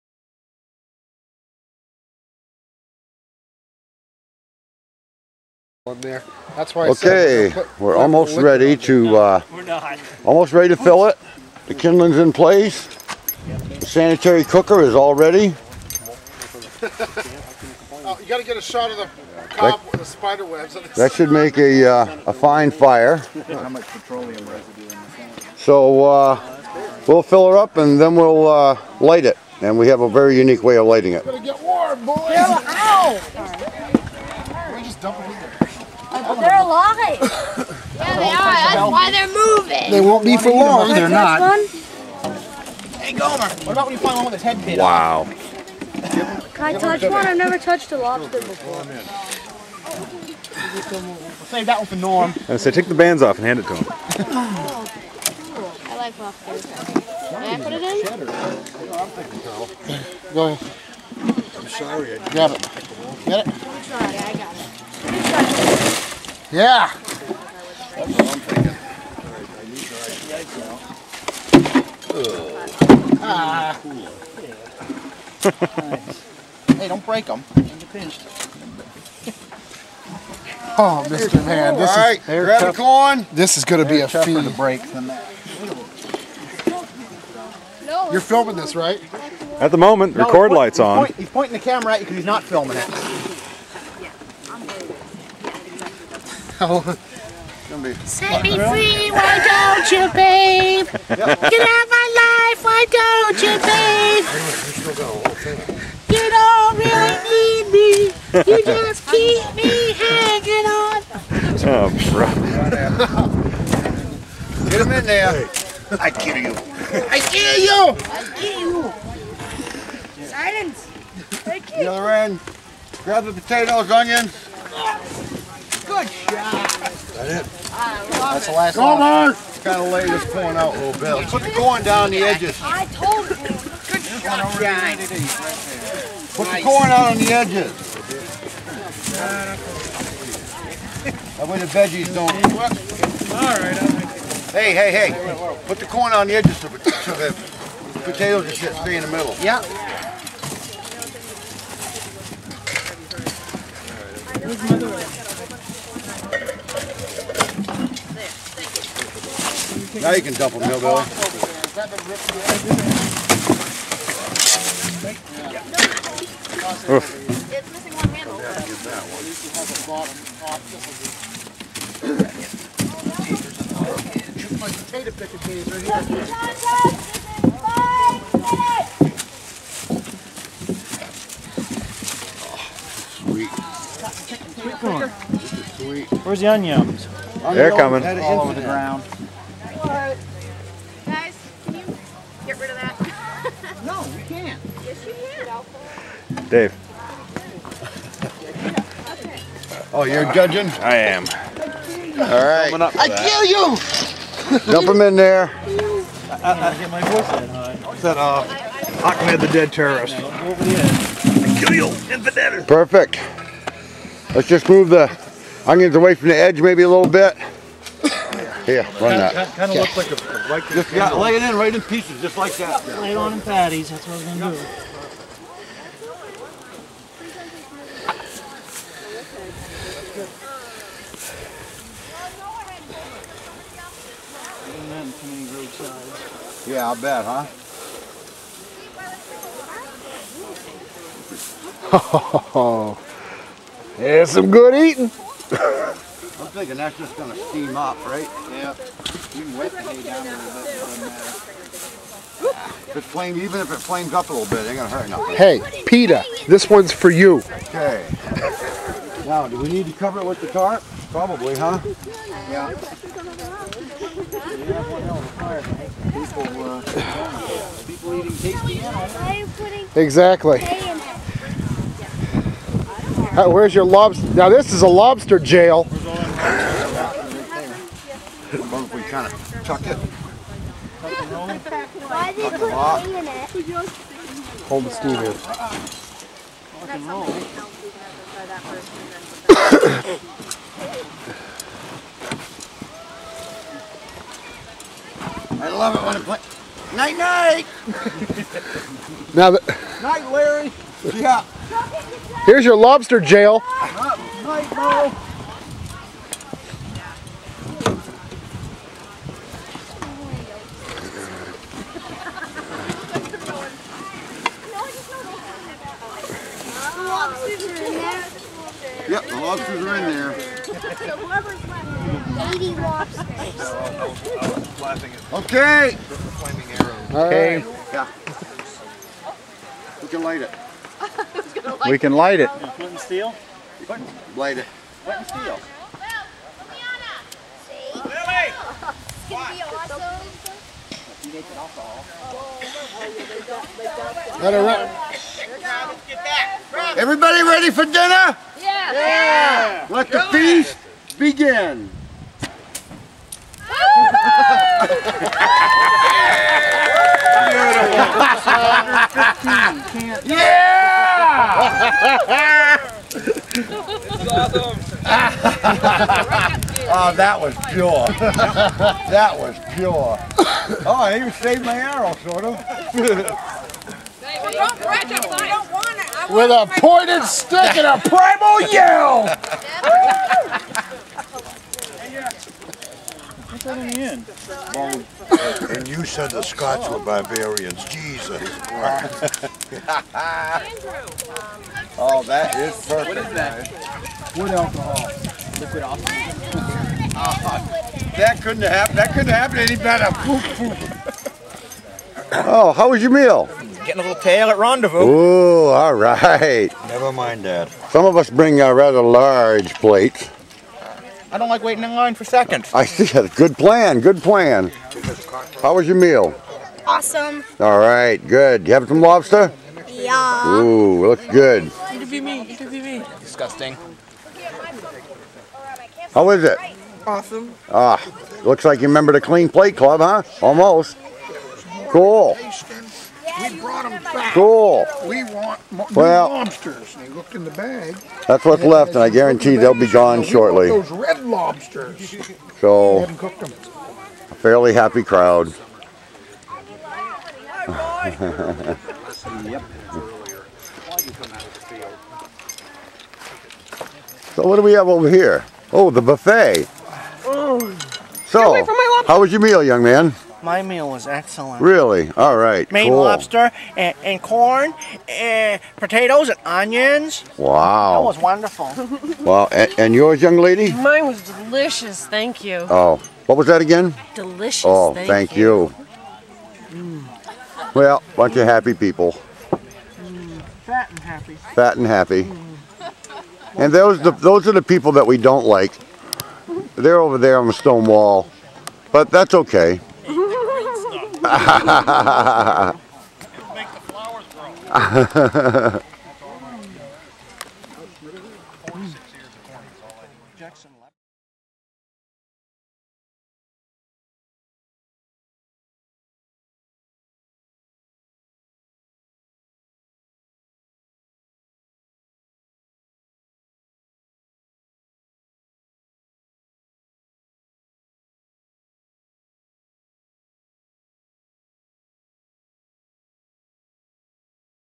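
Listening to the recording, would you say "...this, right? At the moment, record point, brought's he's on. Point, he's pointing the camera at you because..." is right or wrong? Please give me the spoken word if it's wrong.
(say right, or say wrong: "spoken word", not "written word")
wrong: "light", not "brought".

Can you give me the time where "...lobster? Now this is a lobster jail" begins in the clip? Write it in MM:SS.
04:33.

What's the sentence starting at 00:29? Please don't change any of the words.
And we have a very unique way of lighting it.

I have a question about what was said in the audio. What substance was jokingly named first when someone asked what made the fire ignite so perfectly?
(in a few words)
Wood alcohol.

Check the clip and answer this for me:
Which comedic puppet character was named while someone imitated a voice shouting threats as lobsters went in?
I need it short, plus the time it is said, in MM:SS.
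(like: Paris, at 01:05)
Ahmed the Dead Terrorist, at 03:29.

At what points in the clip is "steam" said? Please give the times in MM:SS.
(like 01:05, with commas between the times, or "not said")
04:07, 04:44.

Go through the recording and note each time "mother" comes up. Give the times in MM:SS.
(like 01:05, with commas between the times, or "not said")
02:34.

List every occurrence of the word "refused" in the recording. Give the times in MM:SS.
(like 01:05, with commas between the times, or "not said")
not said.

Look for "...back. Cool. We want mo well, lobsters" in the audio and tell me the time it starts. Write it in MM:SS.
07:14.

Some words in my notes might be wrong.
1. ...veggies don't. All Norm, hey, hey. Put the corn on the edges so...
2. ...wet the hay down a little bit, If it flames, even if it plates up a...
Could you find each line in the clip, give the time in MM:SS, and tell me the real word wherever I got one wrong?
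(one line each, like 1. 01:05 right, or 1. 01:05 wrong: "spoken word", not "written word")
1. 02:21 wrong: "Hey", not "Norm"
2. 04:09 wrong: "flames", not "plates".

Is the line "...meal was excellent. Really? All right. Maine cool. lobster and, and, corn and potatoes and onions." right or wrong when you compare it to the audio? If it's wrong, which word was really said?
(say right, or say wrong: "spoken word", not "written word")
right.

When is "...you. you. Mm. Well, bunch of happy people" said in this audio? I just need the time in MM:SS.
07:55.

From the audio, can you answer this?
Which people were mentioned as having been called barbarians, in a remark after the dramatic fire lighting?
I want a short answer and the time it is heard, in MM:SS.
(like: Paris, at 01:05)
The Scots, at 06:26.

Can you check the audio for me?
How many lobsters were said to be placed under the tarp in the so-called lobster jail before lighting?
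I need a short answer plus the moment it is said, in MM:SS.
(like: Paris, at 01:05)
80, at 05:20.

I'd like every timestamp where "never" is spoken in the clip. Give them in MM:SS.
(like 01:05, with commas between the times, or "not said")
00:47, 06:46.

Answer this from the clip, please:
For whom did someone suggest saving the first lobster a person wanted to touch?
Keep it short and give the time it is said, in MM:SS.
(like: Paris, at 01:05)
Norm, at 00:51.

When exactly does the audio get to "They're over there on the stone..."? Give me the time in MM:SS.
08:06.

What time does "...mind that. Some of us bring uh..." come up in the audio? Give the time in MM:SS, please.
06:47.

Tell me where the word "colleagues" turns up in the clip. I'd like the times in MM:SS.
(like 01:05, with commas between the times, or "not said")
not said.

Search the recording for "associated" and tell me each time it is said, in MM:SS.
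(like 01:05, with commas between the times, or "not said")
not said.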